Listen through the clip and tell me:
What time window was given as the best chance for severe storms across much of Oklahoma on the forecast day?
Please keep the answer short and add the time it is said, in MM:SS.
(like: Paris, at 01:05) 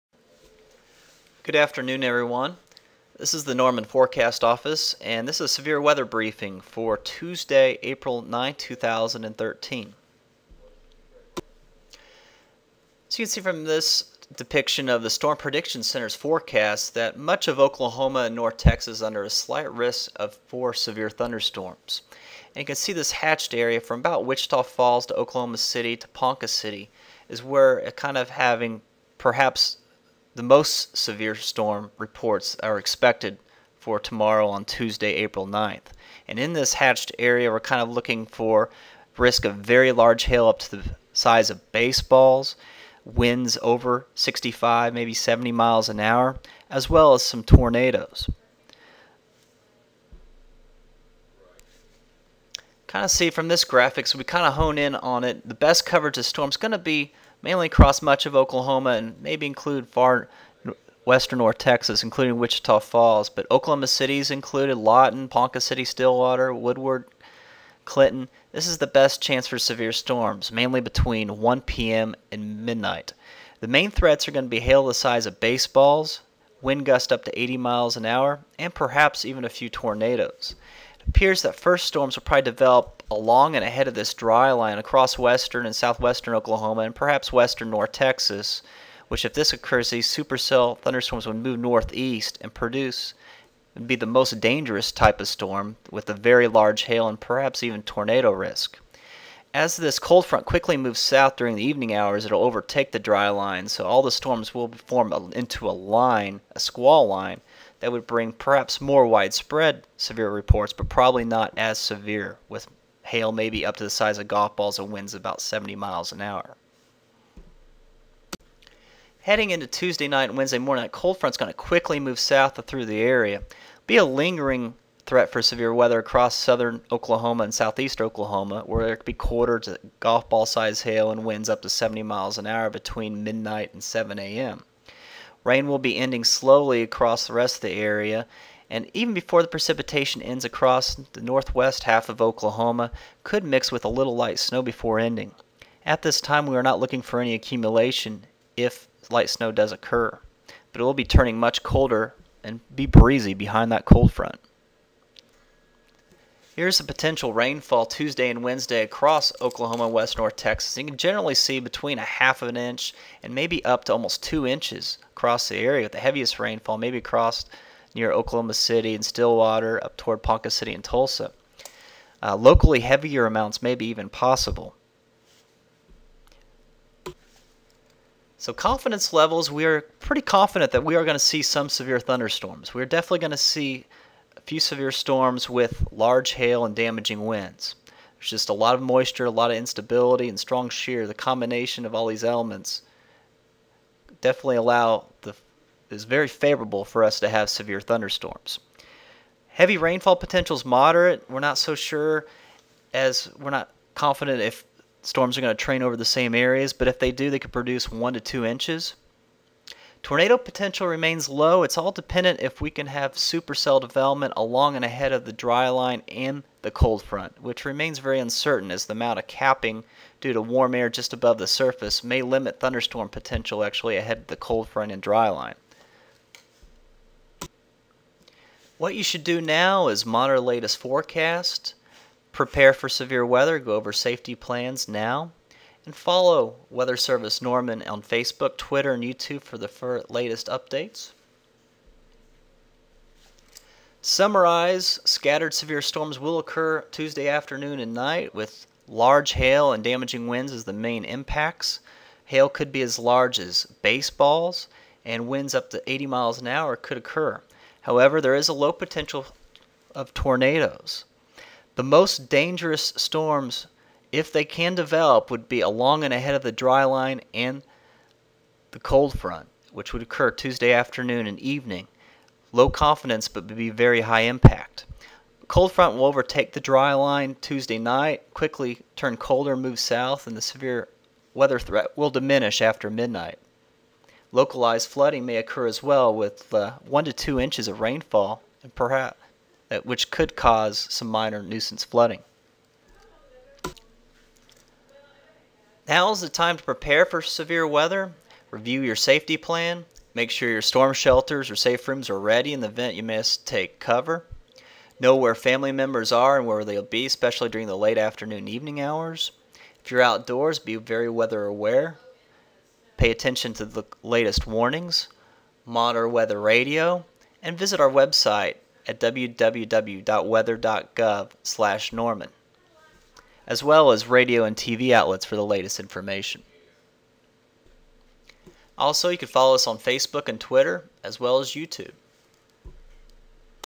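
1 p.m. to midnight, at 01:10.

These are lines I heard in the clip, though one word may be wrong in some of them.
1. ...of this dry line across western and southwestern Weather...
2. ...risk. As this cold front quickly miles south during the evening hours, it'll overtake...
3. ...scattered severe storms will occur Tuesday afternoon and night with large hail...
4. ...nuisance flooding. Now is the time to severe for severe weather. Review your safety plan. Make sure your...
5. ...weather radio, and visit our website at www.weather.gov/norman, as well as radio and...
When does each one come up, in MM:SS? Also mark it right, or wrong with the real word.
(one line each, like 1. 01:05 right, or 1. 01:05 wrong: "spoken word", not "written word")
1. 01:23 wrong: "Oklahoma", not "Weather"
2. 01:38 wrong: "moves", not "miles"
3. 04:05 right
4. 04:51 wrong: "prepare", not "severe"
5. 05:16 right.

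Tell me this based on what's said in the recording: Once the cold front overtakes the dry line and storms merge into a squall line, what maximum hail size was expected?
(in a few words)
golf balls.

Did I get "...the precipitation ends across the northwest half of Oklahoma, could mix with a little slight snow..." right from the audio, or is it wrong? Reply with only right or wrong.
wrong.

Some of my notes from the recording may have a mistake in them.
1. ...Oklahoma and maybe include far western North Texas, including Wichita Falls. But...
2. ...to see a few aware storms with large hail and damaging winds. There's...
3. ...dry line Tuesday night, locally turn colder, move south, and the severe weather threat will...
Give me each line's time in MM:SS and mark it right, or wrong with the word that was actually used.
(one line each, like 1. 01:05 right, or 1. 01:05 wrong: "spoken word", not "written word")
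1. 00:58 right
2. 03:03 wrong: "severe", not "aware"
3. 04:36 wrong: "quickly", not "locally".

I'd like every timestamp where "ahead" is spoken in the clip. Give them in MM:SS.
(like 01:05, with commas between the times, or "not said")
01:23, 03:34, 03:43, 04:26.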